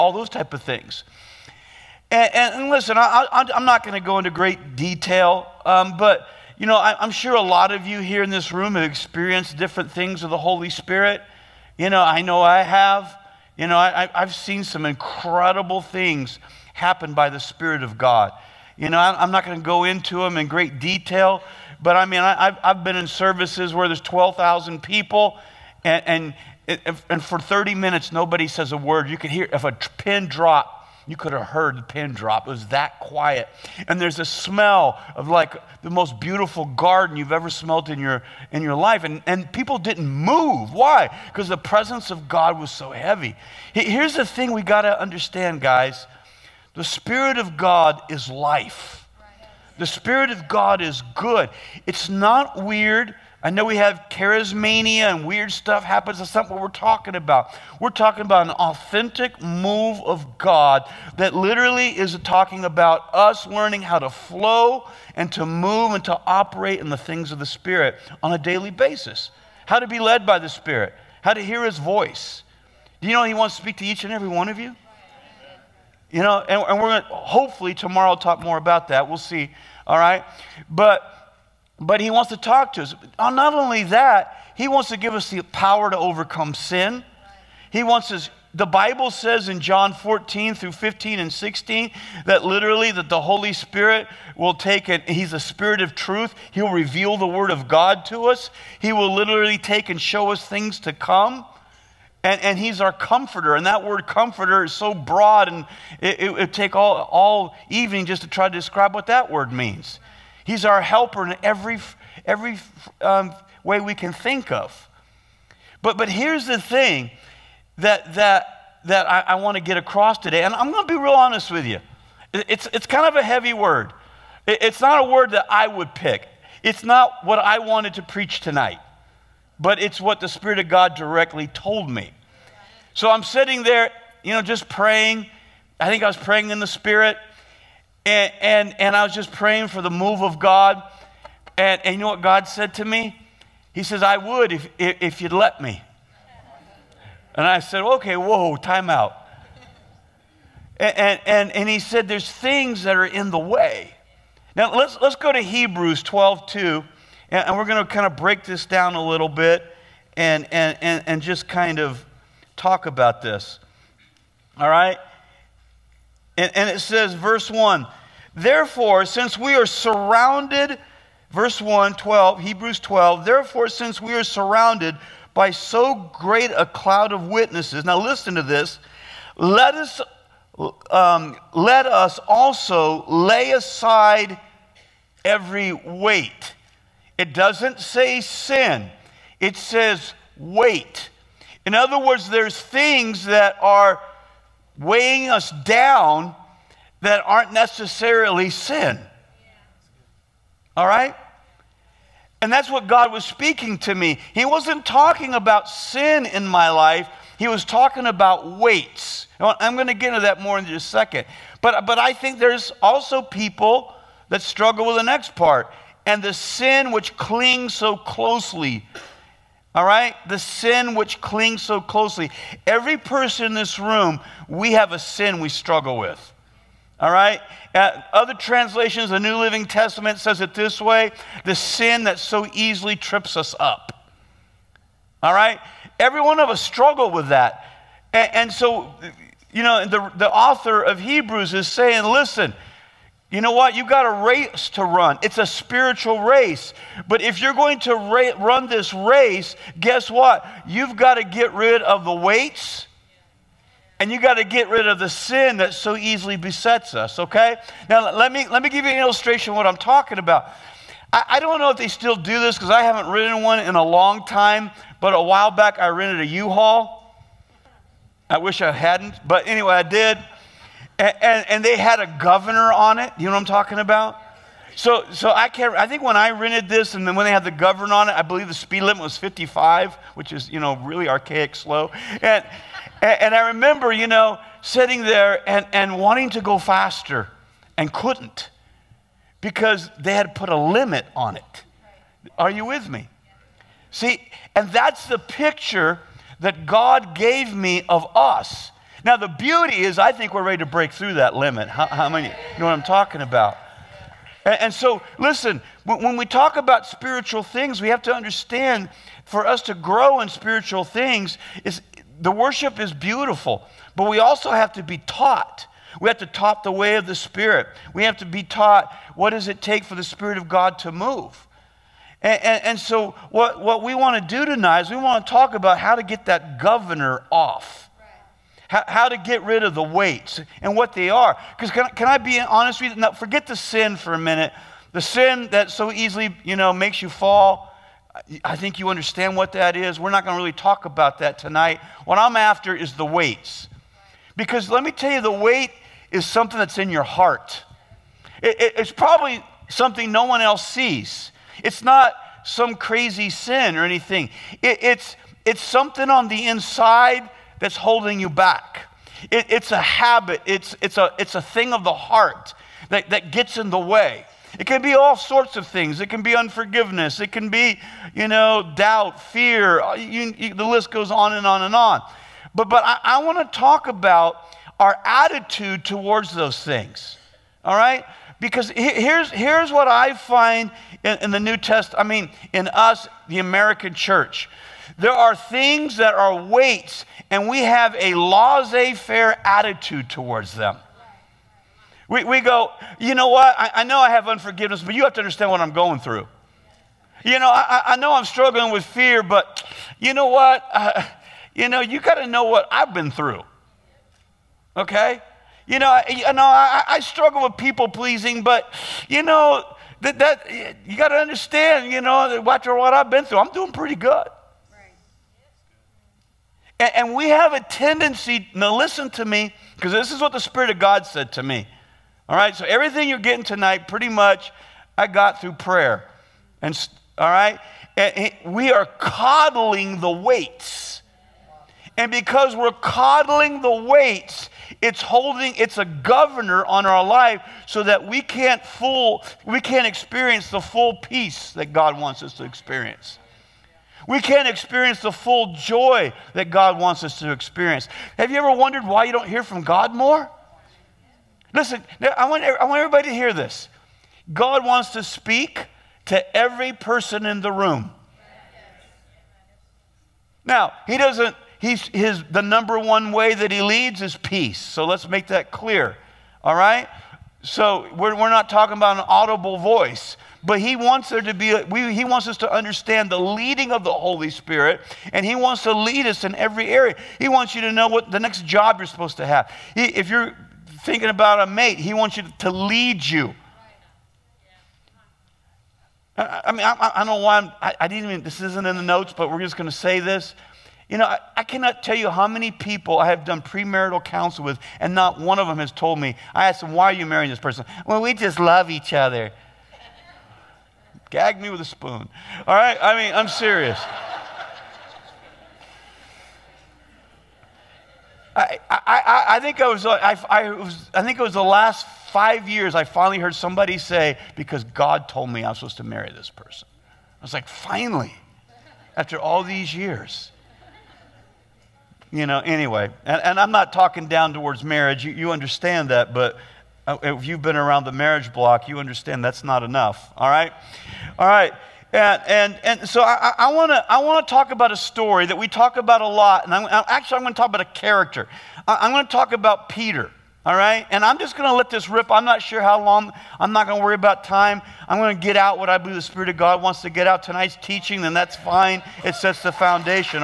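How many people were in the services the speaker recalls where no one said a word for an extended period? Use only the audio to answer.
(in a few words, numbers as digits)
12,000.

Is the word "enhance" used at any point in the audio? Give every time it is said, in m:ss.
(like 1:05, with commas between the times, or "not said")
not said.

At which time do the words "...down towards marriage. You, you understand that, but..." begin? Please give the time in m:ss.
8:44.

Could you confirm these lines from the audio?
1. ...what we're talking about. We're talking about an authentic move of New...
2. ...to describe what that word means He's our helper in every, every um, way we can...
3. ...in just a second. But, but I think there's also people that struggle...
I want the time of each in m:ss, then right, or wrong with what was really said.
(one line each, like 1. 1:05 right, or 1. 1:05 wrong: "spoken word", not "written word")
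1. 0:56 wrong: "God", not "New"
2. 1:48 right
3. 3:30 right.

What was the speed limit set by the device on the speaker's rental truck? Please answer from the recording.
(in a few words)
55.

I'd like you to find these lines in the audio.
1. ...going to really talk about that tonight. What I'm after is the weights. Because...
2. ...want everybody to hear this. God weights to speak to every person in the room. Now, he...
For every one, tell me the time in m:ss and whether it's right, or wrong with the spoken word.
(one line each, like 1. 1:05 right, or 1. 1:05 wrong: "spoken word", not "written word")
1. 5:40 right
2. 7:32 wrong: "wants", not "weights".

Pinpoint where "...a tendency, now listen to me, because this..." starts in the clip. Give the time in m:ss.
6:57.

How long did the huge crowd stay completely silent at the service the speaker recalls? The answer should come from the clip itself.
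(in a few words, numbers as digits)
30 minutes.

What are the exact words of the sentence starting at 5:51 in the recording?
It's not some crazy sin or anything.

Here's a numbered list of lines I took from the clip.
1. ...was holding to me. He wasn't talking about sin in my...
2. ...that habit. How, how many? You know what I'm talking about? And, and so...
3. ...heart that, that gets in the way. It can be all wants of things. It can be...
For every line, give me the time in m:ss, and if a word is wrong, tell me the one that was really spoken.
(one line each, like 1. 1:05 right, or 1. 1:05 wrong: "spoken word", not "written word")
1. 3:23 wrong: "speaking", not "holding"
2. 5:01 wrong: "limit", not "habit"
3. 6:01 wrong: "sorts", not "wants".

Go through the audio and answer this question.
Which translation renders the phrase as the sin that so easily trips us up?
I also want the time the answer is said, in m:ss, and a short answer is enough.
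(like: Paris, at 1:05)
New Living Testament, at 3:49.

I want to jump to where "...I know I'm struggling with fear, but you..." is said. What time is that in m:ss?
6:37.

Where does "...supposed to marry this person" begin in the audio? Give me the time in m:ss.
8:35.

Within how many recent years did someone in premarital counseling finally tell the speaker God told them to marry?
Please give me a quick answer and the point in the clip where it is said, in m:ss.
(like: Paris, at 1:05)
5, at 8:32.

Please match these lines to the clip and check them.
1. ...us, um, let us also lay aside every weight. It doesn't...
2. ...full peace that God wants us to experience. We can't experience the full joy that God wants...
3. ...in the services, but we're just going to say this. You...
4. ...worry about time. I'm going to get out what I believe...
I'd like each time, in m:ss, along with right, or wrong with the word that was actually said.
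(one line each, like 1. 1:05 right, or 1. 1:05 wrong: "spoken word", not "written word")
1. 2:59 right
2. 7:20 right
3. 8:08 wrong: "notes", not "services"
4. 9:03 right.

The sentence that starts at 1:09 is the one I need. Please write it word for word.
How to be led by the Spirit, how to hear His voice.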